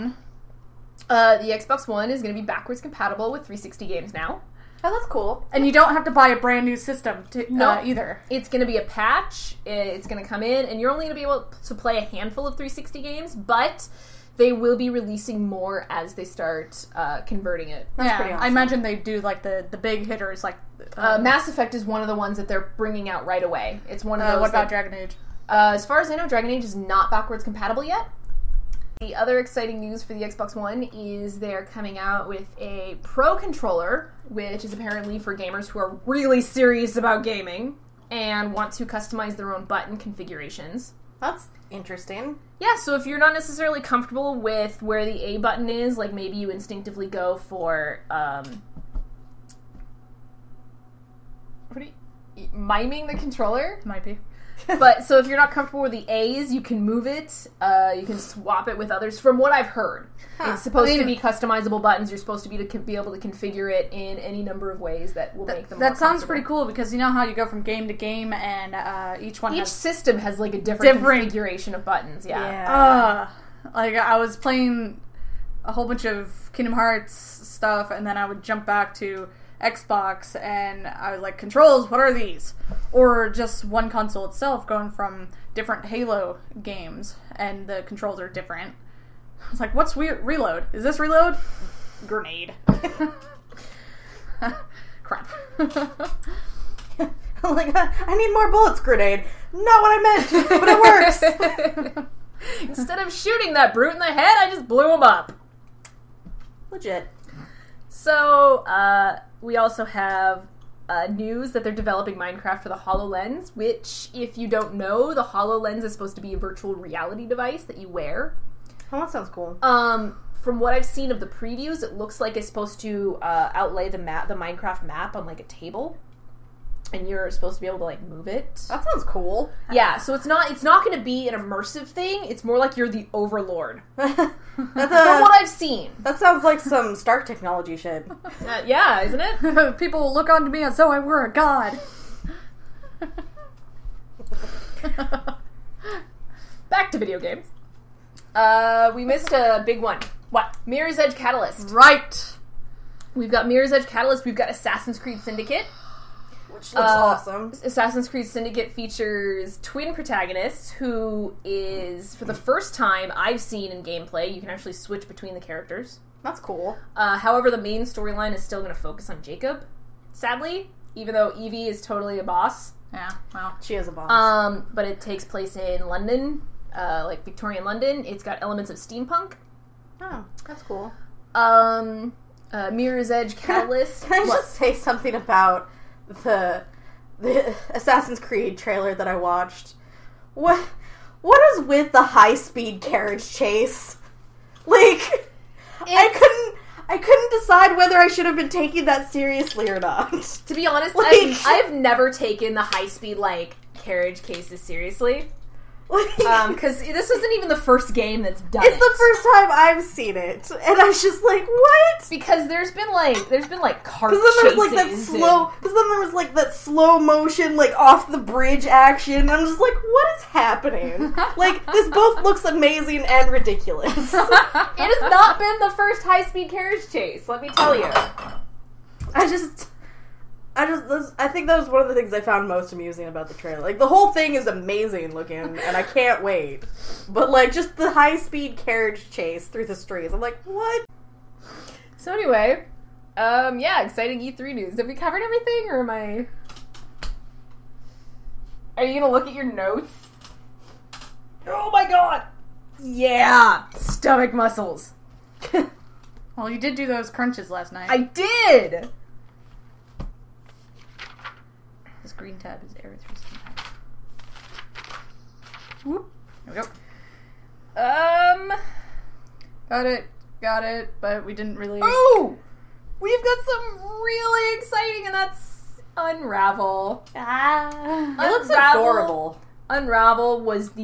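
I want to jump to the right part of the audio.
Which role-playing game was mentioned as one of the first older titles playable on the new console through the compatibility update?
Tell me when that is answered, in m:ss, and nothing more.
0:21.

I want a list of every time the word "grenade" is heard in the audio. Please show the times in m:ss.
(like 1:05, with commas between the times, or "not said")
1:32, 1:38.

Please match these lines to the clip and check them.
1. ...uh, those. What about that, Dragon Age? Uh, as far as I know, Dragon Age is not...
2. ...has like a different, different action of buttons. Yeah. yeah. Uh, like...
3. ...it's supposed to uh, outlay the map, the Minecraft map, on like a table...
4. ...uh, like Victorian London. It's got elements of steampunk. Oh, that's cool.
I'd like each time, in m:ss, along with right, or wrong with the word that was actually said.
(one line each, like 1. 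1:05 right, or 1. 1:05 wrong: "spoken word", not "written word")
1. 0:24 right
2. 1:10 wrong: "configuration", not "action"
3. 2:02 right
4. 2:56 right.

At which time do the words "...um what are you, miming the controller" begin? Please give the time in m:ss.
0:48.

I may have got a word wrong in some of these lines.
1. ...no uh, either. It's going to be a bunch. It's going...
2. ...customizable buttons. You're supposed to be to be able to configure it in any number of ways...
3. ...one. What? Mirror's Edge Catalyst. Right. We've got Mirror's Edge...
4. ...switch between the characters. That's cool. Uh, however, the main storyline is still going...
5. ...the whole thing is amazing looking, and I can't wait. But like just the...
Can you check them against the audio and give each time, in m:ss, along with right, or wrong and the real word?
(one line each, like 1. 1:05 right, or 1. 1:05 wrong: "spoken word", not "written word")
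1. 0:07 wrong: "patch", not "bunch"
2. 1:01 right
3. 2:29 right
4. 2:44 right
5. 3:53 right.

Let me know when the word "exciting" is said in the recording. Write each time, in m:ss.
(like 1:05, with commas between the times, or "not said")
0:29, 4:03, 4:34.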